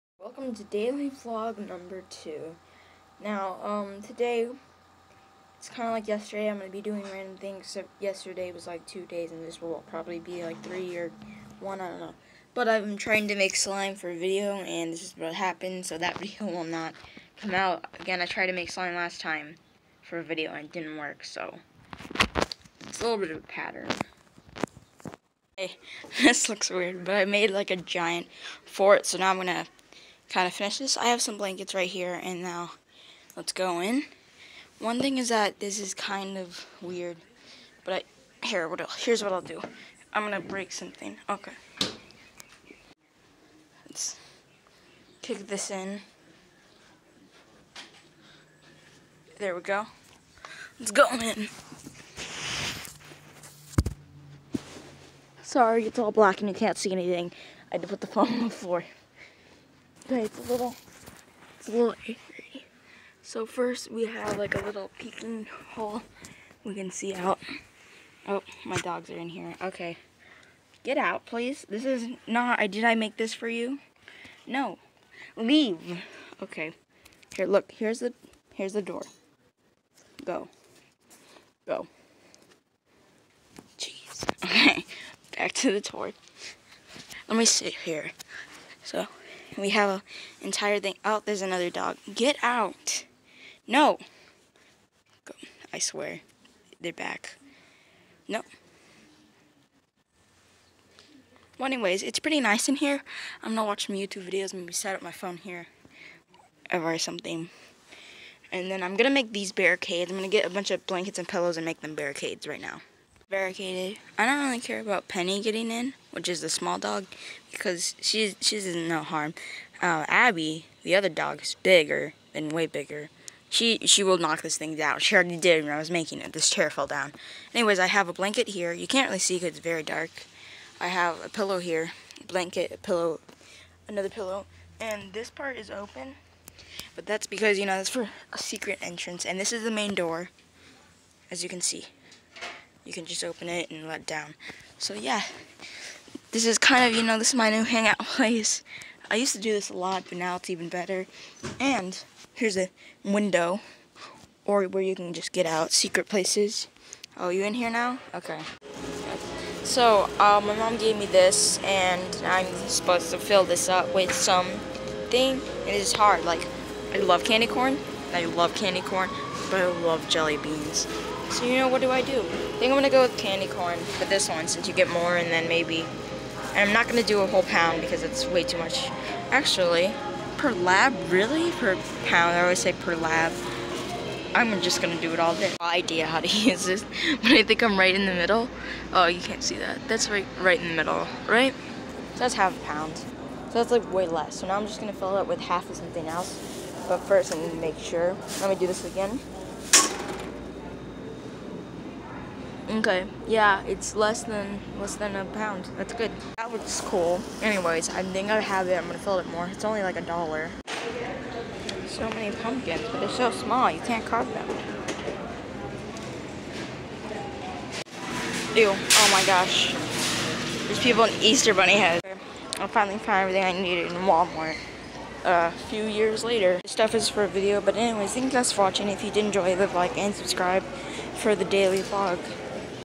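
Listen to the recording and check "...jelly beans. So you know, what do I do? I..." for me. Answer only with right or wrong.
right.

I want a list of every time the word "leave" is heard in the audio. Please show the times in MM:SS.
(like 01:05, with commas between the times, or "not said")
01:15, 03:49.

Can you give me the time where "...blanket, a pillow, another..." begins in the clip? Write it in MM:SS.
02:12.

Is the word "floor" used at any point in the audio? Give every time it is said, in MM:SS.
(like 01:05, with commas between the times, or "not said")
00:58.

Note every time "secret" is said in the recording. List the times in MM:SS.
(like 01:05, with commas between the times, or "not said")
02:18, 02:35.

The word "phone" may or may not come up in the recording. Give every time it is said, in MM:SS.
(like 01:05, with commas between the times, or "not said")
00:58, 01:45.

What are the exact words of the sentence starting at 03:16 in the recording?
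But first, need gonna make sure.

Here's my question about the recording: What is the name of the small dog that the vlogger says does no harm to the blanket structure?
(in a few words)
Penny.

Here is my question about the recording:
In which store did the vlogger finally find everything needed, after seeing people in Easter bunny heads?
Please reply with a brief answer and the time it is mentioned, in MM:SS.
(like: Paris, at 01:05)
Walmart, at 03:44.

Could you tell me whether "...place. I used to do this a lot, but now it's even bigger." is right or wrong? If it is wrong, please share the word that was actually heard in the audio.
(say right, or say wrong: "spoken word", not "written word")
wrong: "better", not "bigger".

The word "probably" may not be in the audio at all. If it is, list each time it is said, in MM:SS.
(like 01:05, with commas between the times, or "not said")
00:09.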